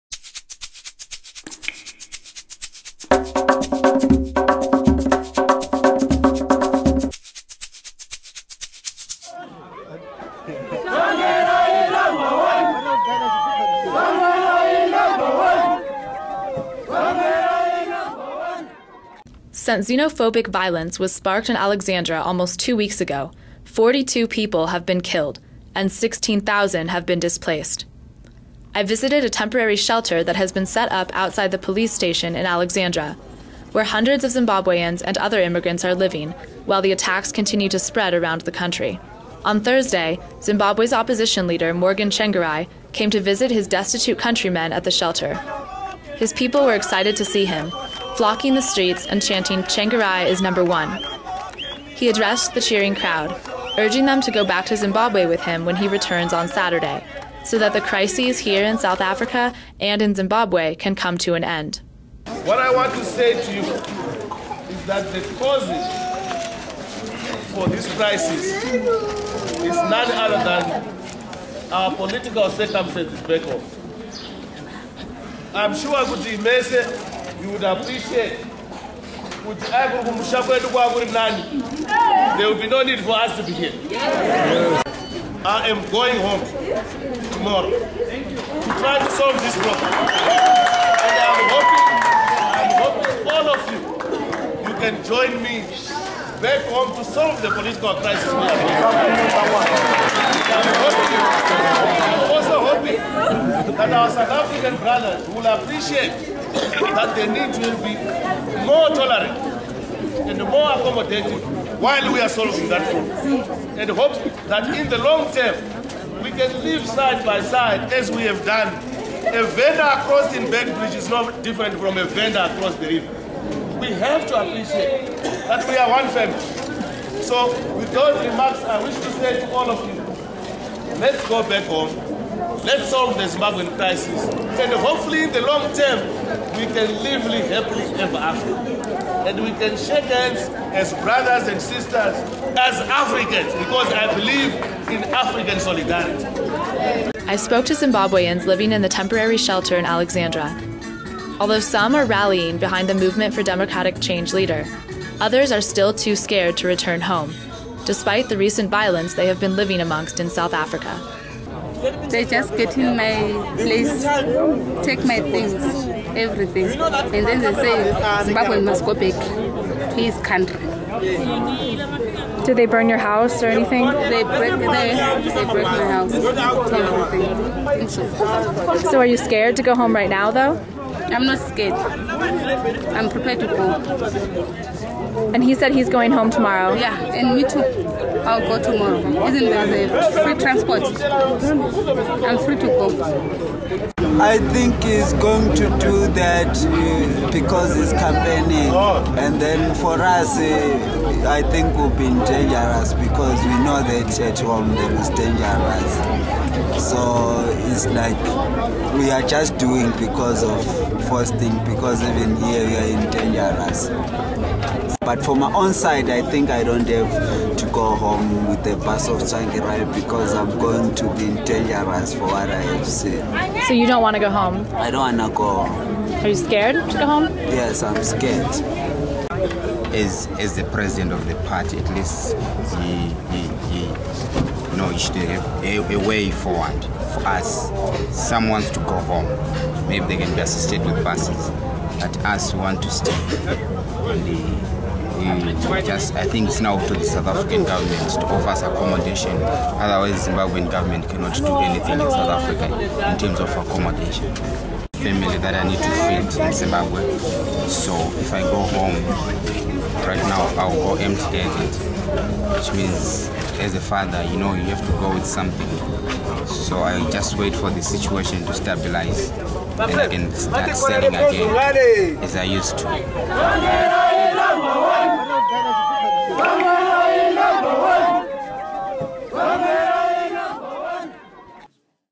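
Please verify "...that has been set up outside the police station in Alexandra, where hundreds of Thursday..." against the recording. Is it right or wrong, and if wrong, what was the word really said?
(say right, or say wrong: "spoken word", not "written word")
wrong: "Zimbabweans", not "Thursday".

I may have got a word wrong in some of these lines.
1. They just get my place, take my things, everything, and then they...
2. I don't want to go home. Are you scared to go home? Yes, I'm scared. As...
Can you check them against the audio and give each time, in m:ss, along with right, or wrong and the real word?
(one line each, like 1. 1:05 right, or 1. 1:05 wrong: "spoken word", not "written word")
1. 2:42 right
2. 3:44 right.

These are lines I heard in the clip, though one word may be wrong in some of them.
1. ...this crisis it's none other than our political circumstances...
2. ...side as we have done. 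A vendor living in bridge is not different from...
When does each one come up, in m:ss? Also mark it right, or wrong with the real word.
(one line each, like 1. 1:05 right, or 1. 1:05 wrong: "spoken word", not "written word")
1. 1:07 right
2. 1:57 wrong: "crossing", not "living".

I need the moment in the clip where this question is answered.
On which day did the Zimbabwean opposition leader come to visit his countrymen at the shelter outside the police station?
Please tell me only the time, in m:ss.
0:39.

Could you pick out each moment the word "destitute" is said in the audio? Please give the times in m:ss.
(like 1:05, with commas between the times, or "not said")
0:43.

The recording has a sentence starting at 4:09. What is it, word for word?
Otherwise, Zimbabwean government cannot do anything in South Africa in terms of accommodation.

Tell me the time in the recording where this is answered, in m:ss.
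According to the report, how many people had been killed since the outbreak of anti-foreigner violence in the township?
0:23.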